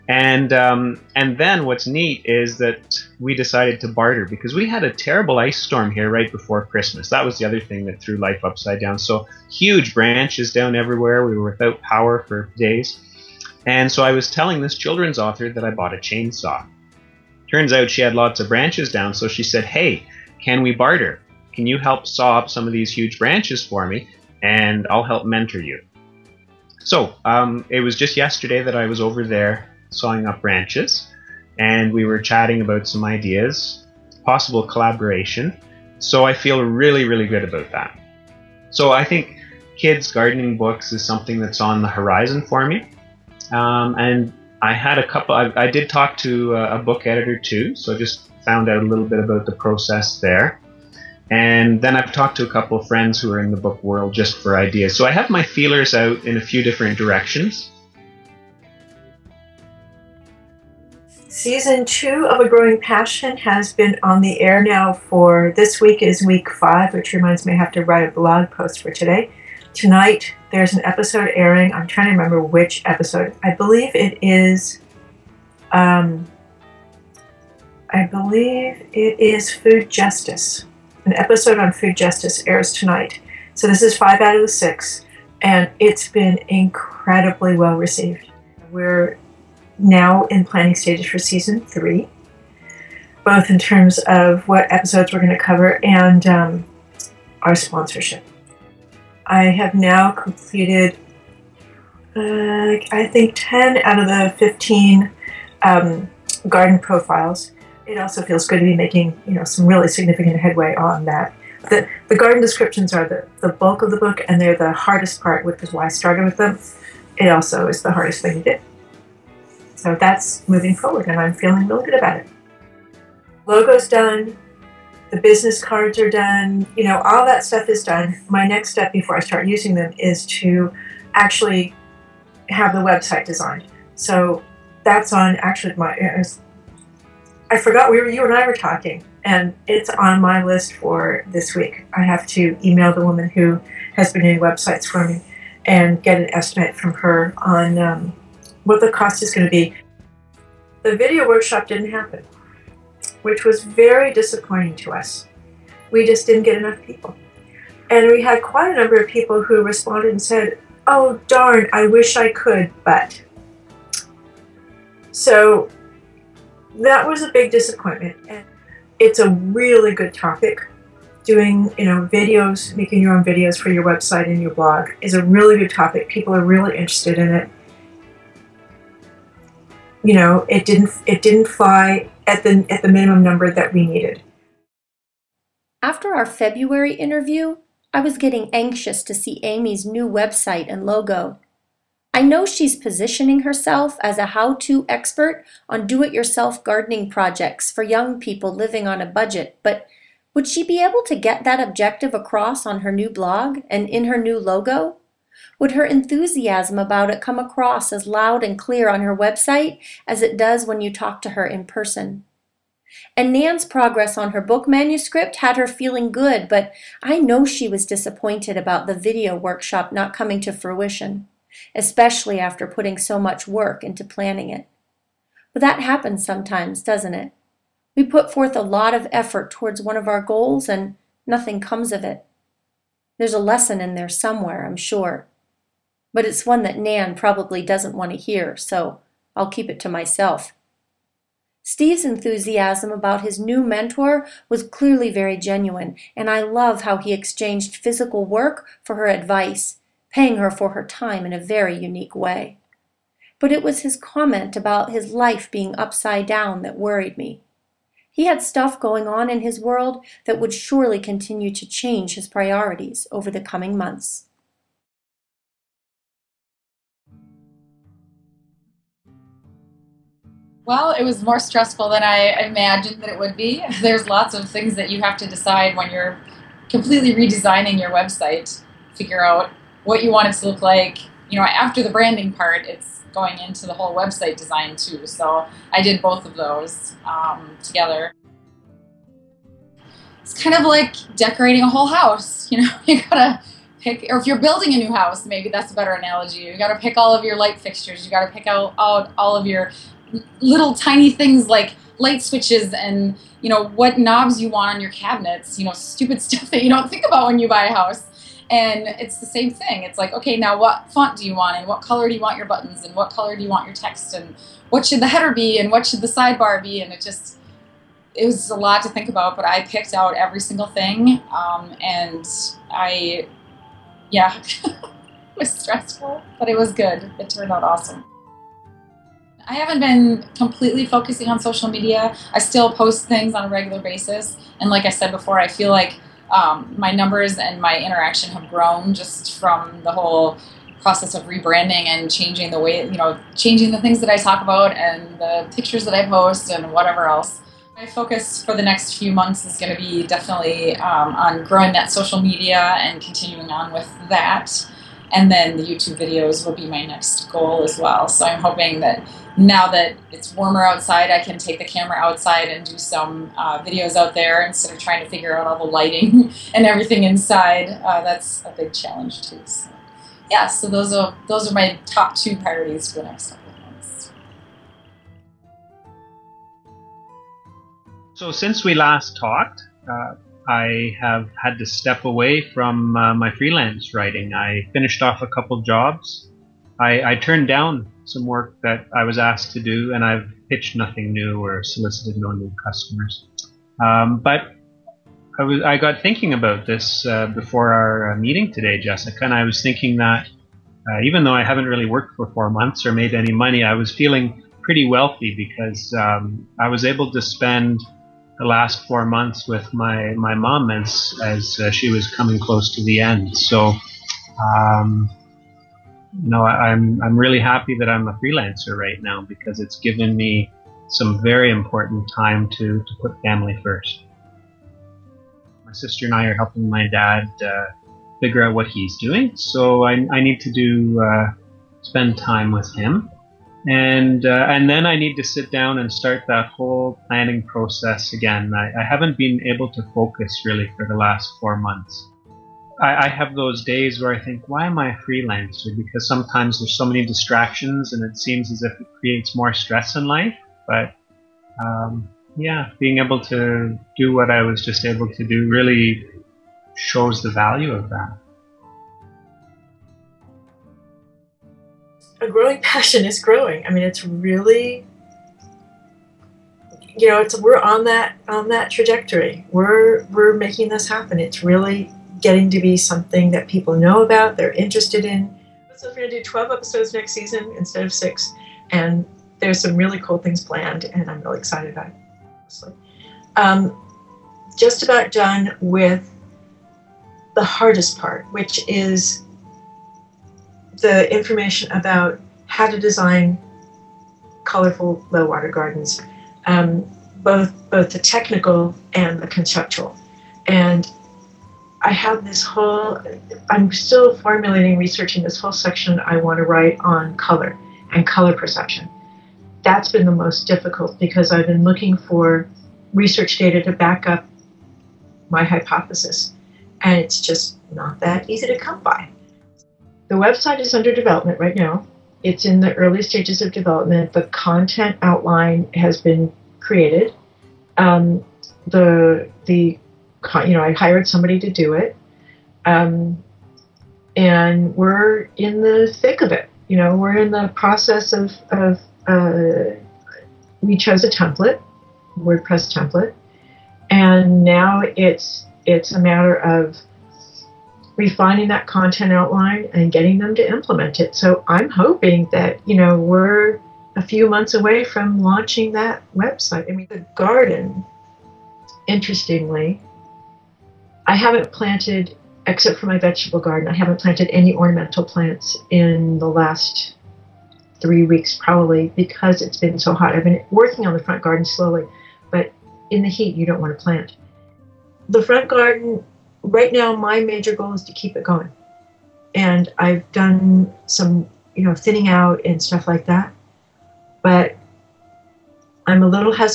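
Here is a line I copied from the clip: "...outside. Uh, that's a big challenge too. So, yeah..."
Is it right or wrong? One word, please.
wrong.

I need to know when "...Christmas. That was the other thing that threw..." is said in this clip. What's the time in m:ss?
0:06.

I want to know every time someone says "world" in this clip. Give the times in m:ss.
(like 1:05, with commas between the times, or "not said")
0:53, 4:19.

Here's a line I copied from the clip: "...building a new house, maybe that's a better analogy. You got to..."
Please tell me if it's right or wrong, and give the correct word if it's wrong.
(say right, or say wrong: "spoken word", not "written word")
right.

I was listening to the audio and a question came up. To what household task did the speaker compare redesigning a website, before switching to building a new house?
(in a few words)
Decorating a whole house.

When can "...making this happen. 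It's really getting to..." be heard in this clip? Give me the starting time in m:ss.
7:50.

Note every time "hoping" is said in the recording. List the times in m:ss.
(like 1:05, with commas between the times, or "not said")
5:58, 9:11.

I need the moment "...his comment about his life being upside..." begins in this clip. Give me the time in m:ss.
4:13.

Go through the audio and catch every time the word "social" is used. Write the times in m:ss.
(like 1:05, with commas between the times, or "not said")
5:31, 5:51.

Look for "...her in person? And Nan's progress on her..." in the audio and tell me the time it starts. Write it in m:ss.
3:31.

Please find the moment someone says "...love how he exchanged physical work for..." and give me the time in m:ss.
4:06.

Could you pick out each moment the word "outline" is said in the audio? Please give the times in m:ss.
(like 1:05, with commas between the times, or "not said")
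8:45, 9:09.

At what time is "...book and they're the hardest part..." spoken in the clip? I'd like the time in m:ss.
1:53.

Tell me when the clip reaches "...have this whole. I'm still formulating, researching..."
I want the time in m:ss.
8:21.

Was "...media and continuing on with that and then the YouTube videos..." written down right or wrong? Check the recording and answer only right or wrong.
right.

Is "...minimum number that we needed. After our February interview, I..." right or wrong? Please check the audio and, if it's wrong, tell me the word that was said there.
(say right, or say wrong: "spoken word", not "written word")
right.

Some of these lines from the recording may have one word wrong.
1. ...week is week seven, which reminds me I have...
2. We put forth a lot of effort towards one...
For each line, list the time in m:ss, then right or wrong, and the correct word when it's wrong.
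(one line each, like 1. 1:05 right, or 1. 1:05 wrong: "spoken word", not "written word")
1. 1:05 wrong: "five", not "seven"
2. 3:47 right.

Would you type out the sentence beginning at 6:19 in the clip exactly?
Uh I have had to step away from uh, my freelance writing.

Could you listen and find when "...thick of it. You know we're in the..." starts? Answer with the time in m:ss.
8:56.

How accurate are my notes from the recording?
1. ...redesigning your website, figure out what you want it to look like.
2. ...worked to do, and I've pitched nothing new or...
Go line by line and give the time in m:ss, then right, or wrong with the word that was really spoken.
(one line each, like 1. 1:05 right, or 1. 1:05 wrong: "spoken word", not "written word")
1. 4:37 right
2. 6:29 wrong: "asked", not "worked".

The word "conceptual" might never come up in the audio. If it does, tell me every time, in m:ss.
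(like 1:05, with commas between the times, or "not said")
8:19.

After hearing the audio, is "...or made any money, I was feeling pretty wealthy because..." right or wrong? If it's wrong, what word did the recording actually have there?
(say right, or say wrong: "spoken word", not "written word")
right.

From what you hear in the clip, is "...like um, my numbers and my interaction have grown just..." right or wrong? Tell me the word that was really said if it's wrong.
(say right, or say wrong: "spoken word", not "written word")
right.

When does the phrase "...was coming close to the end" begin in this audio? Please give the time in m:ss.
6:51.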